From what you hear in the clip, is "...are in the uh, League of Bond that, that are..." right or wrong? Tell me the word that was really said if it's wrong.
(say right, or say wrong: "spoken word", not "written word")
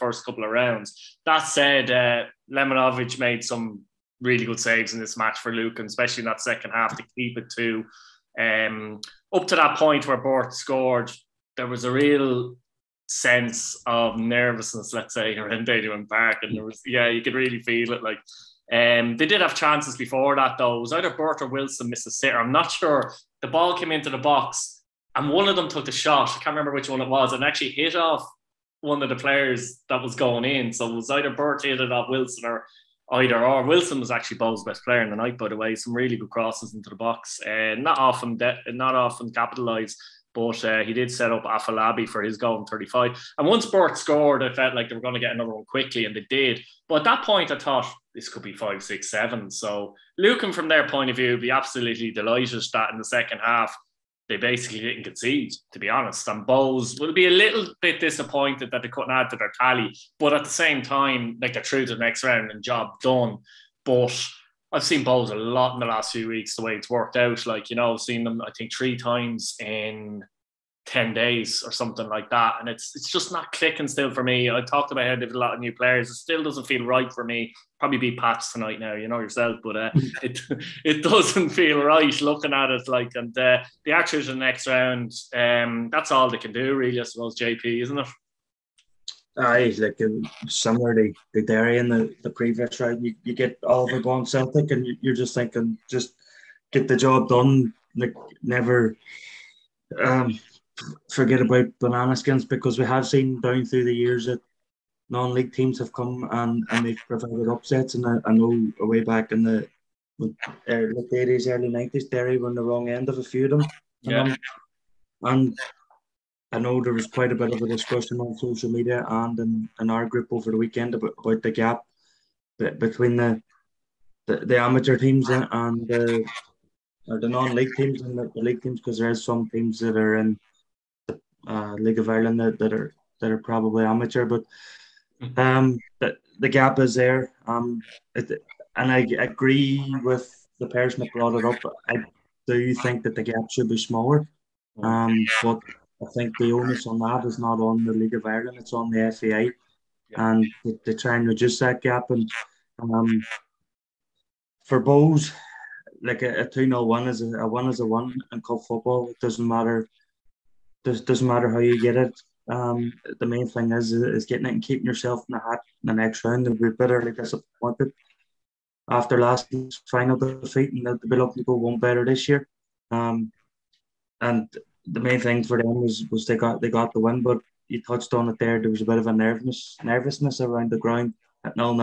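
wrong: "Ireland", not "Bond".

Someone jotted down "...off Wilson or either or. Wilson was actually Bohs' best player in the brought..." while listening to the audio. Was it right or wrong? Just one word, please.
wrong.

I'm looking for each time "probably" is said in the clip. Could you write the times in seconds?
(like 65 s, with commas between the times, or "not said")
77 s, 133 s.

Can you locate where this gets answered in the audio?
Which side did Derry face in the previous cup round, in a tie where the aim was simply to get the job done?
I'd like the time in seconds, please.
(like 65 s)
93 s.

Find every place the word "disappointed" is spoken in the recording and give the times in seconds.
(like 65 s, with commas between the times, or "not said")
58 s, 167 s.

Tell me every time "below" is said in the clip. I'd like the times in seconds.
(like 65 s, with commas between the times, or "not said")
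not said.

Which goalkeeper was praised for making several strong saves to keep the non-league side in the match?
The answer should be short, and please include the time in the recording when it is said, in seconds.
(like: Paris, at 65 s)
Lemanovic, at 2 s.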